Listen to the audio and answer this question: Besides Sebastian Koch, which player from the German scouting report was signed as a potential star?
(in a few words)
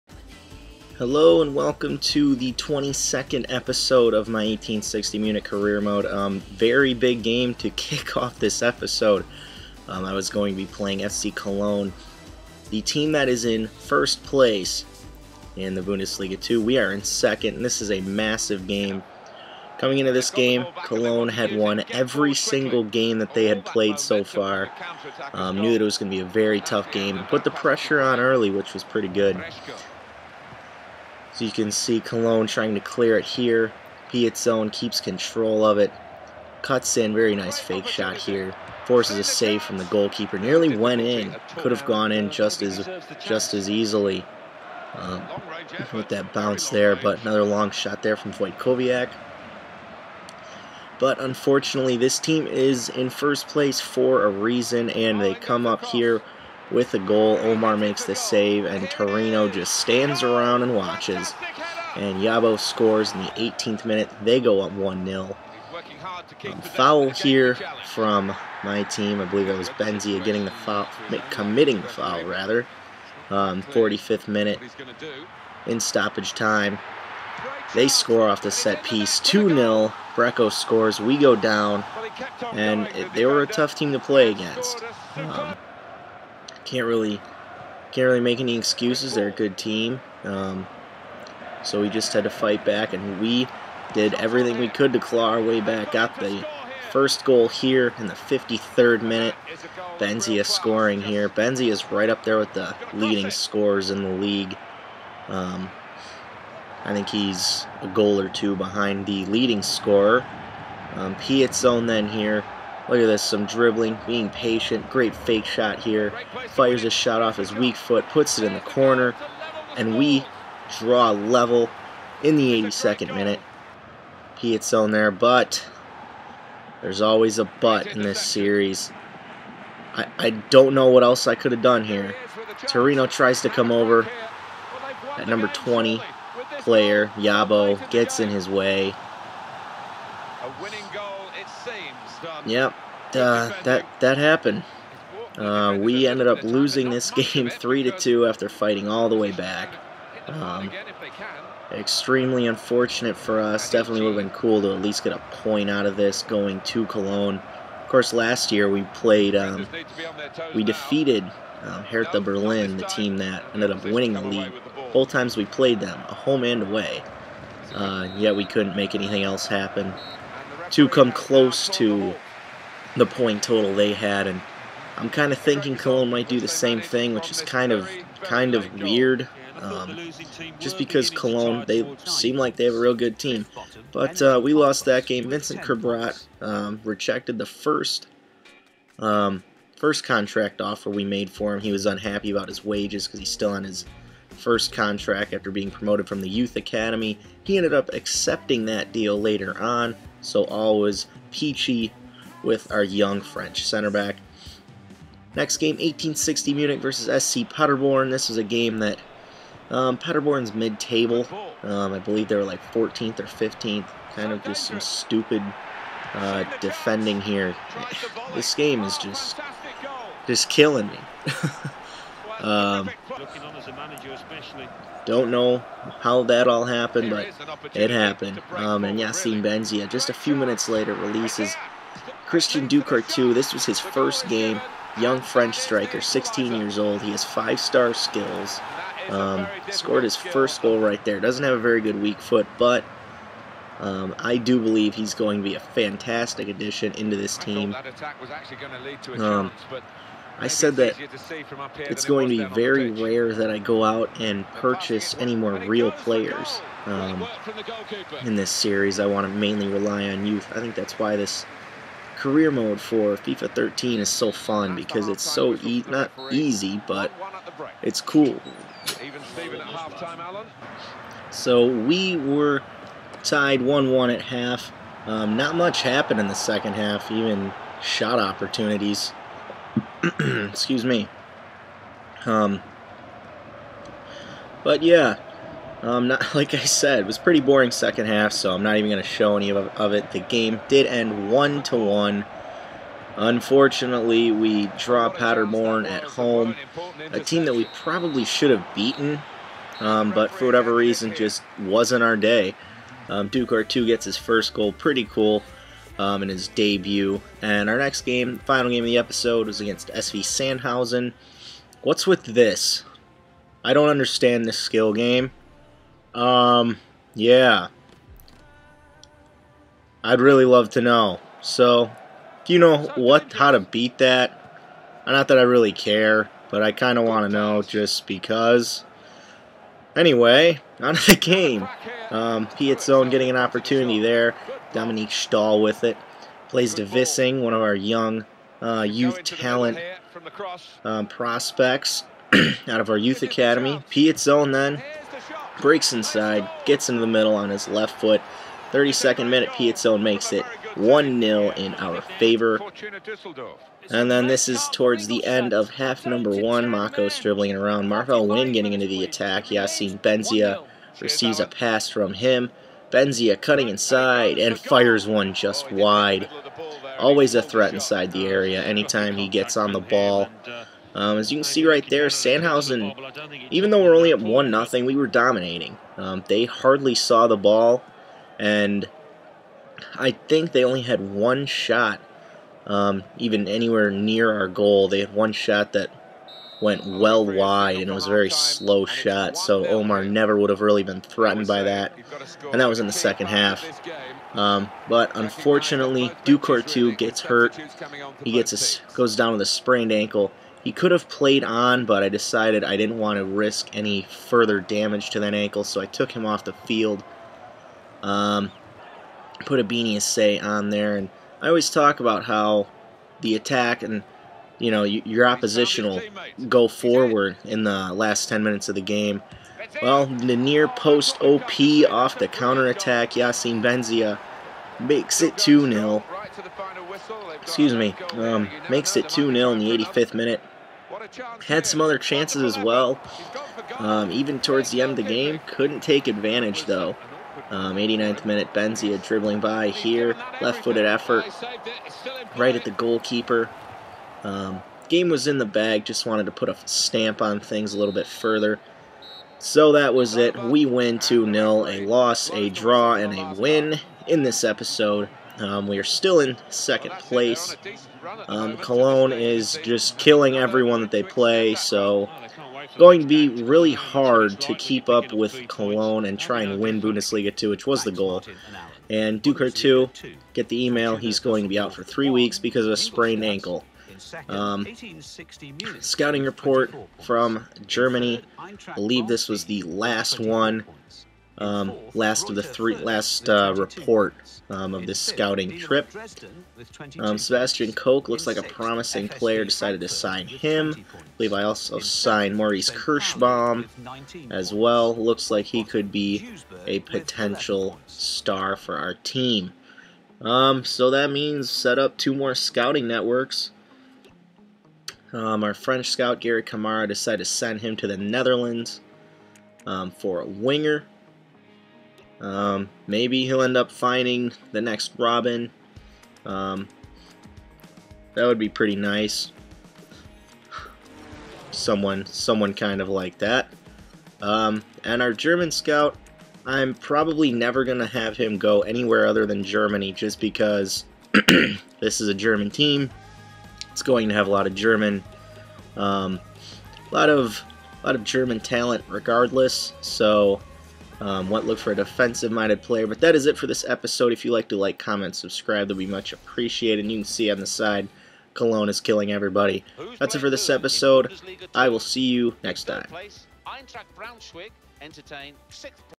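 Maurice Kirschbaum.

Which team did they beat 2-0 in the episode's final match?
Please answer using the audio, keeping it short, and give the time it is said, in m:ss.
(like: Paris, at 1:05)
SV Sandhausen, at 5:09.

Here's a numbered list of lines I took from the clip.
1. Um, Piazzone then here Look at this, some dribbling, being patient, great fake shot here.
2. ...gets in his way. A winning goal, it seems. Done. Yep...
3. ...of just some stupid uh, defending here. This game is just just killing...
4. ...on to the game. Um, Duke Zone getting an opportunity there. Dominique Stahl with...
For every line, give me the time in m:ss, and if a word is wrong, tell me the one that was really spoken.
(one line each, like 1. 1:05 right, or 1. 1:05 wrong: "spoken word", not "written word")
1. 1:50 right
2. 2:17 right
3. 3:34 right
4. 5:30 wrong: "Piet", not "Duke".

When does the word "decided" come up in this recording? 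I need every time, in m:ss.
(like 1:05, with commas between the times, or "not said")
6:42, 8:09, 8:26.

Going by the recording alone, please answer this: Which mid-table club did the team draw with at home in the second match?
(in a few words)
SC Paderborn.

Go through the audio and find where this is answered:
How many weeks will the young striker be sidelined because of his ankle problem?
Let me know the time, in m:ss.
7:51.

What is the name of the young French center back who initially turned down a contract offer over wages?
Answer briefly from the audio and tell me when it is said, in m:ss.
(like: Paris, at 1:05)
Vincent Kerbrat, at 3:05.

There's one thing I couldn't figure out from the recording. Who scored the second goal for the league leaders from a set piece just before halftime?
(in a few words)
Brecco.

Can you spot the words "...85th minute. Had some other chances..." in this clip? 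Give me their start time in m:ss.
7:09.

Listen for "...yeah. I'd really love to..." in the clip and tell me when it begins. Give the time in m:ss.
5:17.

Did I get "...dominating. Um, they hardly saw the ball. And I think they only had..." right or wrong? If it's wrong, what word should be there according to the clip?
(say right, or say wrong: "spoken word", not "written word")
right.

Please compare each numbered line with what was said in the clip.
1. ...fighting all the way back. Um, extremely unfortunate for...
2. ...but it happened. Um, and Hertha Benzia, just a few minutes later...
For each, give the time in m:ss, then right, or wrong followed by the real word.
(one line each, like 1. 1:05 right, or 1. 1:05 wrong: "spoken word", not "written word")
1. 2:28 right
2. 3:47 wrong: "Yassine", not "Hertha".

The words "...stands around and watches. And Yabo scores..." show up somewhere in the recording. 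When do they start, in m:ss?
0:59.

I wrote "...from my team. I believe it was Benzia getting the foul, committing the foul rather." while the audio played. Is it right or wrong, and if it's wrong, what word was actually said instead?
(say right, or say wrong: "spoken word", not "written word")
right.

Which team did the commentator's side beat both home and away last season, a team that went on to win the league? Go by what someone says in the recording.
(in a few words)
Hertha Berlin.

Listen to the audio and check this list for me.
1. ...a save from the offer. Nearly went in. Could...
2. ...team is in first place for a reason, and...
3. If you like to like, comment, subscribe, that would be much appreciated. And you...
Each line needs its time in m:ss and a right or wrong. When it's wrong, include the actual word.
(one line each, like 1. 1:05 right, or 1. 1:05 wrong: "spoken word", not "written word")
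1. 0:39 wrong: "goalkeeper", not "offer"
2. 0:52 right
3. 9:04 right.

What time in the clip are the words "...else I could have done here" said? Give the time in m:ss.
2:11.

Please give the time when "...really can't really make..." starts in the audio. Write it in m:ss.
1:26.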